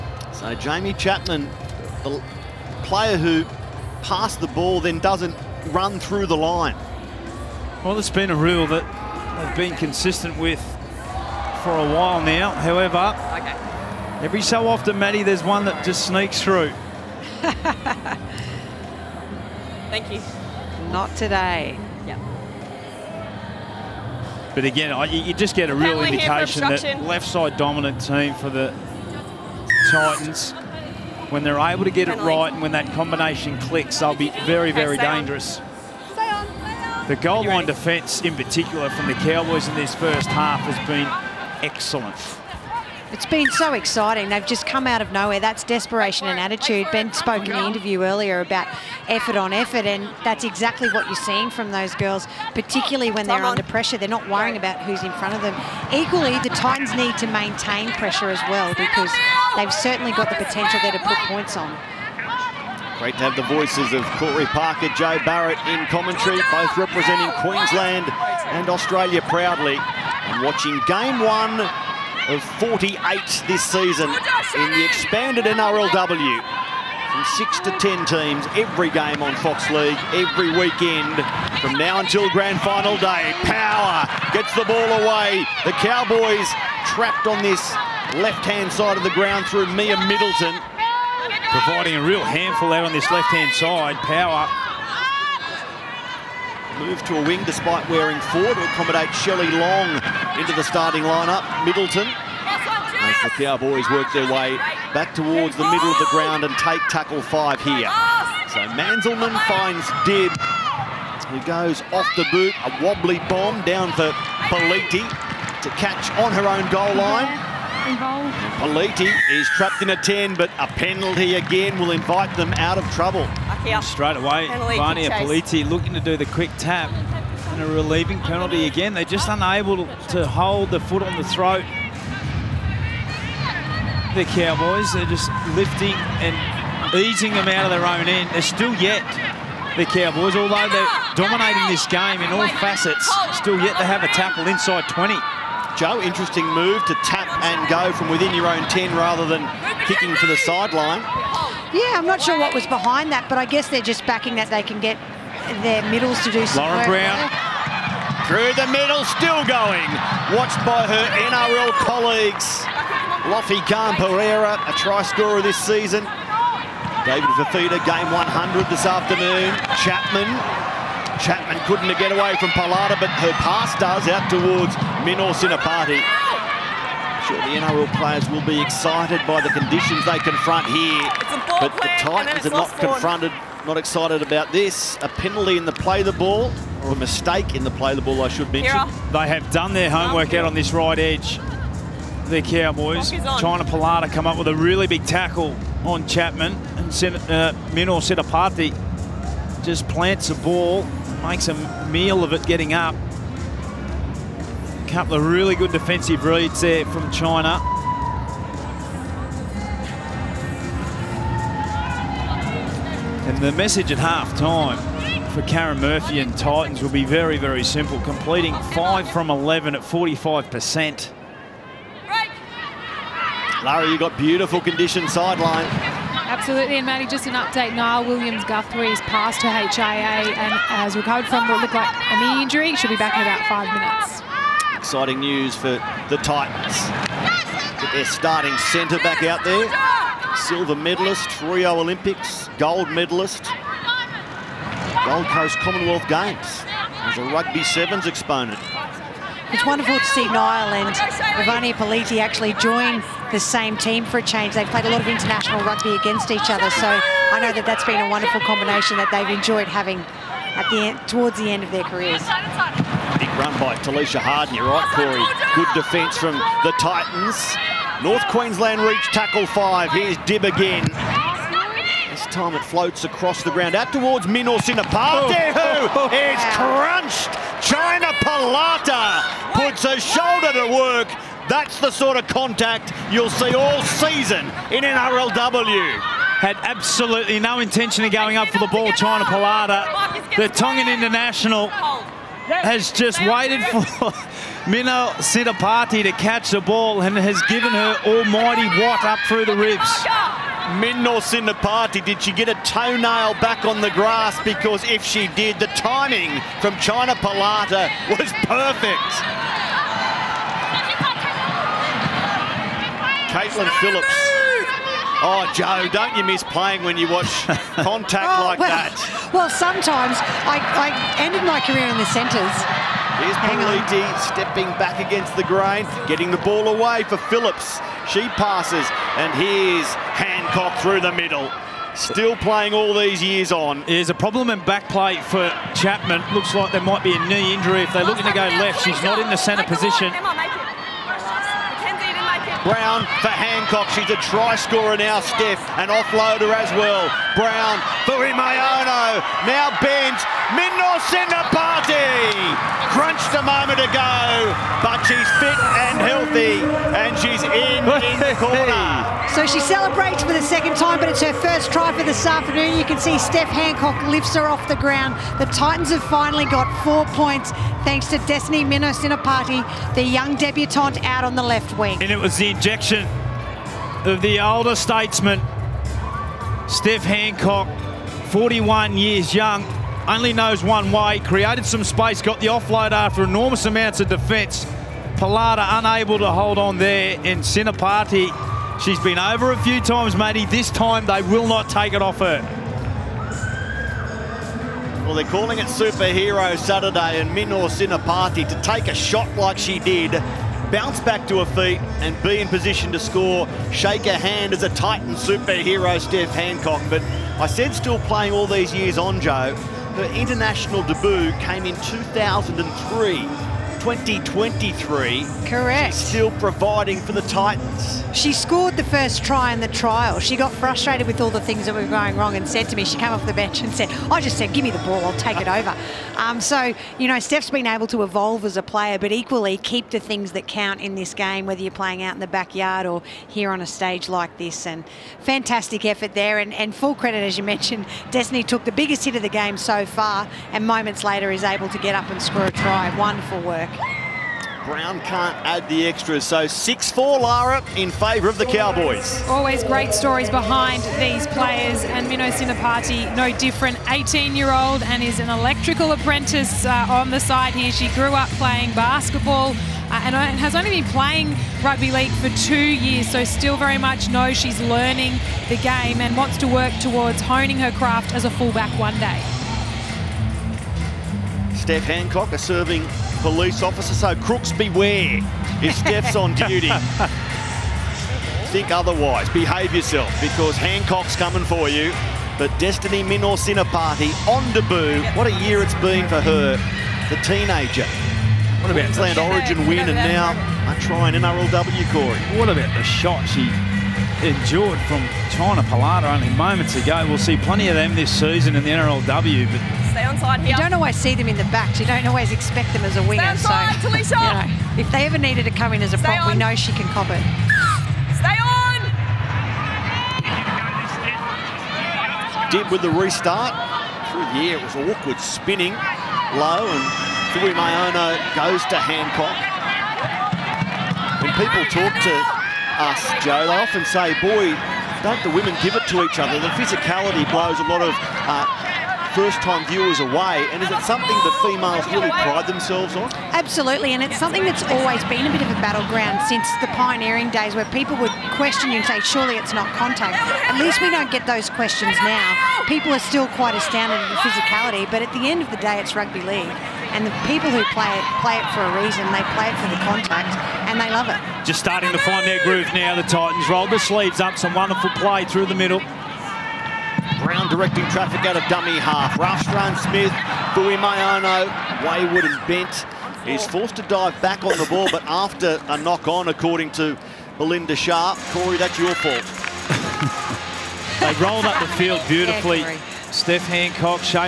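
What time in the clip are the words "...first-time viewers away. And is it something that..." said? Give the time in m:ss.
8:49.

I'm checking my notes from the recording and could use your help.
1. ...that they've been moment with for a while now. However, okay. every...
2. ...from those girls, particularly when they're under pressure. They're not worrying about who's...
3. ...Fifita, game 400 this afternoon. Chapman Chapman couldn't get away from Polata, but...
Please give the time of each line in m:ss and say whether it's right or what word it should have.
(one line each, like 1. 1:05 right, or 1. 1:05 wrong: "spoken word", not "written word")
1. 0:08 wrong: "consistent", not "moment"
2. 0:51 right
3. 2:47 wrong: "100", not "400".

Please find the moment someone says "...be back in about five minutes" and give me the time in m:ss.
3:52.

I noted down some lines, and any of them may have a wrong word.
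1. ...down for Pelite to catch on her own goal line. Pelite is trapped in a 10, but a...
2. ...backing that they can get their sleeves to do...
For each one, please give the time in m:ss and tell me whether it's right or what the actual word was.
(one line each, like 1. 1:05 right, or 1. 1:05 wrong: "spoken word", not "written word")
1. 1:53 right
2. 2:34 wrong: "middles", not "sleeves".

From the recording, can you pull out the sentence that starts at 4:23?
Big run by Talisha Harden, you're right, Corey.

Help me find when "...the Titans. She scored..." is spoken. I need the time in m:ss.
6:57.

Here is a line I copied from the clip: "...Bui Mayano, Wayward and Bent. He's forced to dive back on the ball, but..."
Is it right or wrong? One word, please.
right.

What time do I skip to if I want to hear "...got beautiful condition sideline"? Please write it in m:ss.
3:43.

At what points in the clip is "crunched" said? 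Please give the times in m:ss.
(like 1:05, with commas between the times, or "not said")
4:36, 5:52.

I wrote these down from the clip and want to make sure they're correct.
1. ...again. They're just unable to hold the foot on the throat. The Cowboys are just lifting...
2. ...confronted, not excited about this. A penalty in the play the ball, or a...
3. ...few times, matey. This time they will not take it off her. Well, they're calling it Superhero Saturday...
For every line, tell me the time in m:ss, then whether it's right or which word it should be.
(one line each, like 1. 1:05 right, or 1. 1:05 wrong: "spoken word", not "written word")
1. 2:08 right
2. 3:02 right
3. 6:29 right.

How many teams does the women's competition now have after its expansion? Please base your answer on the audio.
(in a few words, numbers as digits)
10.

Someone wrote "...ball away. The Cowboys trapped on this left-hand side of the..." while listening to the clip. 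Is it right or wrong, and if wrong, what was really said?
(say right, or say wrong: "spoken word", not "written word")
right.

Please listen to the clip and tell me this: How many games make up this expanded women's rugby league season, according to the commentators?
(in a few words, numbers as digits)
48.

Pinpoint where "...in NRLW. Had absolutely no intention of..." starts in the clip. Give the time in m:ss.
4:44.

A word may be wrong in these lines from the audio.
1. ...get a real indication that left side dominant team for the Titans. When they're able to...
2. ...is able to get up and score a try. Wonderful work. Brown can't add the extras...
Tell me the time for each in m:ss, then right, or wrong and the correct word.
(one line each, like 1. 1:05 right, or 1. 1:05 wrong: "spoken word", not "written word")
1. 0:25 right
2. 7:21 right.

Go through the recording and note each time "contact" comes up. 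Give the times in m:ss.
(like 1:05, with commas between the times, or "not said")
4:42, 5:17, 8:59, 9:09.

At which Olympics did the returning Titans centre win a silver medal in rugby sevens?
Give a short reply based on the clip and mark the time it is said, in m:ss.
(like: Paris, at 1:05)
Rio Olympics, at 4:01.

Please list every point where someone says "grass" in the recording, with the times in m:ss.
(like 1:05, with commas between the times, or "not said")
5:03.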